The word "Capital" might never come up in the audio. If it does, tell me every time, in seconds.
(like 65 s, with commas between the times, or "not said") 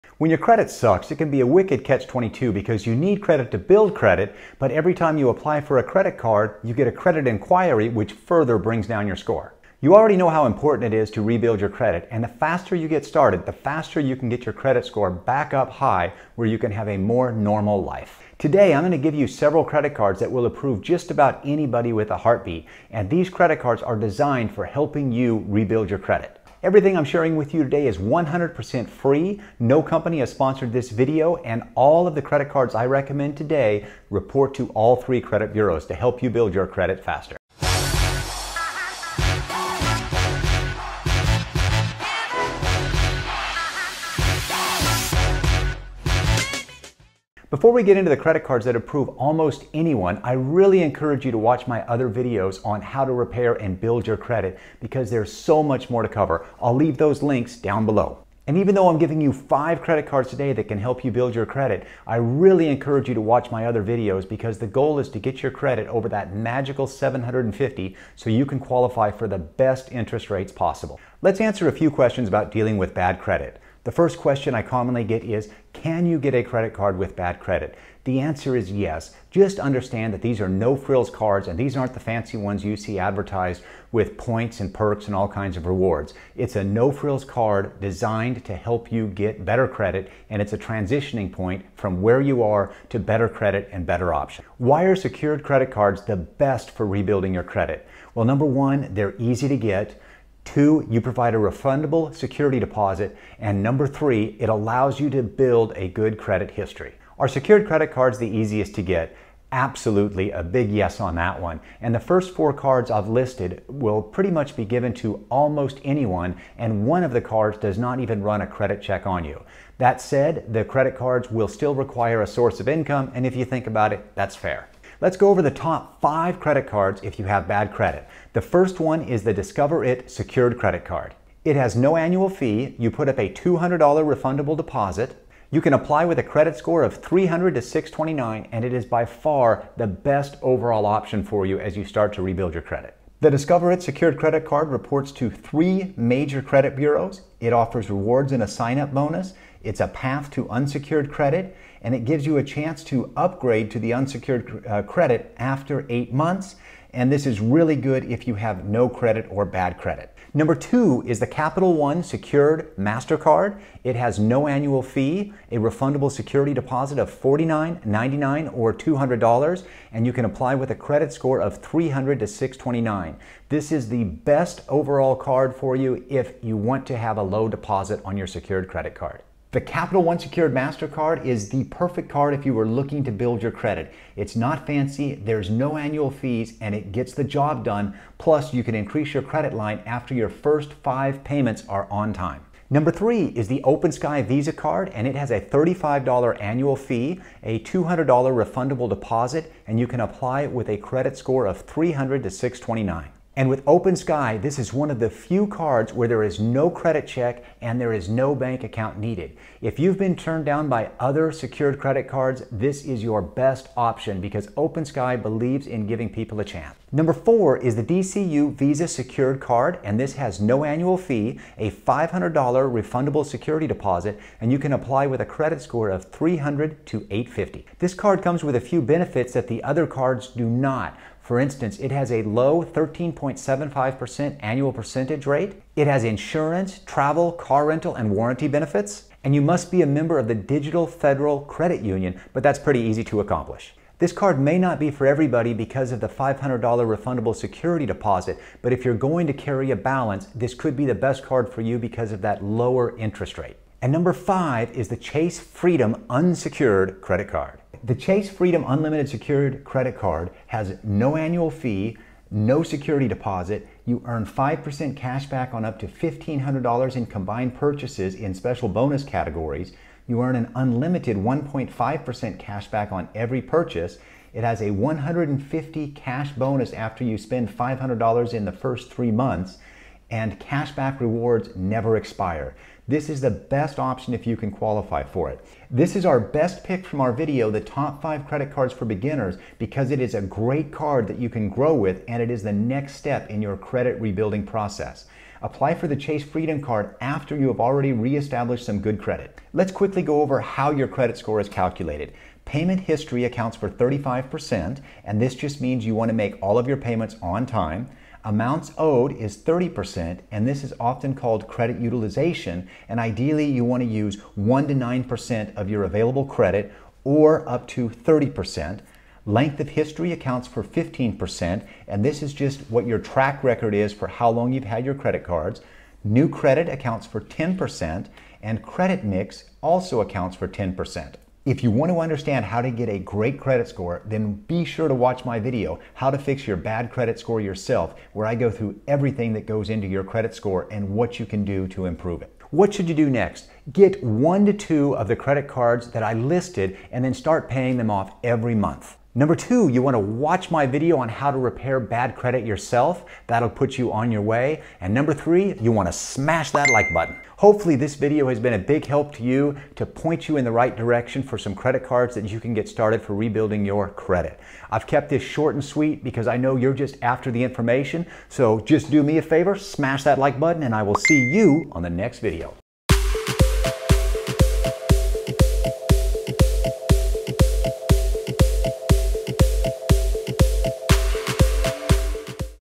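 161 s, 179 s.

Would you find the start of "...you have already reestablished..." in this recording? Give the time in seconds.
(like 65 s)
297 s.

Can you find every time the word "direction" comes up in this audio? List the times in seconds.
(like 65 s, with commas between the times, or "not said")
360 s.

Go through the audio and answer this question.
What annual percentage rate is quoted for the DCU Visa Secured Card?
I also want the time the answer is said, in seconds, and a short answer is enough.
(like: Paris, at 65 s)
13.75%, at 232 s.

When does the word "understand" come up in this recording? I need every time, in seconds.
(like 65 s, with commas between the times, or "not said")
79 s, 331 s.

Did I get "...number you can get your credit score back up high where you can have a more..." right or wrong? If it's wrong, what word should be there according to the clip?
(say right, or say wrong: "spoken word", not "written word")
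wrong: "faster", not "number".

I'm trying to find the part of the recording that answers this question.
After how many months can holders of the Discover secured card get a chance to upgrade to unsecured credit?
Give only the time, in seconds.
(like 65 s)
155 s.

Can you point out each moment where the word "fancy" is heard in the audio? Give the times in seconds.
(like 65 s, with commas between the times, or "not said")
81 s, 184 s.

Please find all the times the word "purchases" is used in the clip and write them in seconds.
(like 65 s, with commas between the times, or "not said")
267 s, 273 s.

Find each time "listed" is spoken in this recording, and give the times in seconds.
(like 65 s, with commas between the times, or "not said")
113 s, 346 s.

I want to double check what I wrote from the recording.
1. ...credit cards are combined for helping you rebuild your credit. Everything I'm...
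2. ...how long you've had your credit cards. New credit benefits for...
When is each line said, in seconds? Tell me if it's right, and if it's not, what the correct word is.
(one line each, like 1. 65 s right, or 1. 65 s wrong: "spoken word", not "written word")
1. 23 s wrong: "designed", not "combined"
2. 324 s wrong: "accounts", not "benefits".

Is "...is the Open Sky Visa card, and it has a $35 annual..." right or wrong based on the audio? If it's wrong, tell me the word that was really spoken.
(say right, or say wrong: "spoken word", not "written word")
right.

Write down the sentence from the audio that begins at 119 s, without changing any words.
That said, the credit cards will still require a source of income, and if you think about it, that's fair.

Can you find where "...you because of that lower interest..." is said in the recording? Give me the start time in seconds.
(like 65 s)
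251 s.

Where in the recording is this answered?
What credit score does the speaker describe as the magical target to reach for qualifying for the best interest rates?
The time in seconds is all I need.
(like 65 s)
66 s.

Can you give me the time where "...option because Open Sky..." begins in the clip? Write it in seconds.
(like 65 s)
213 s.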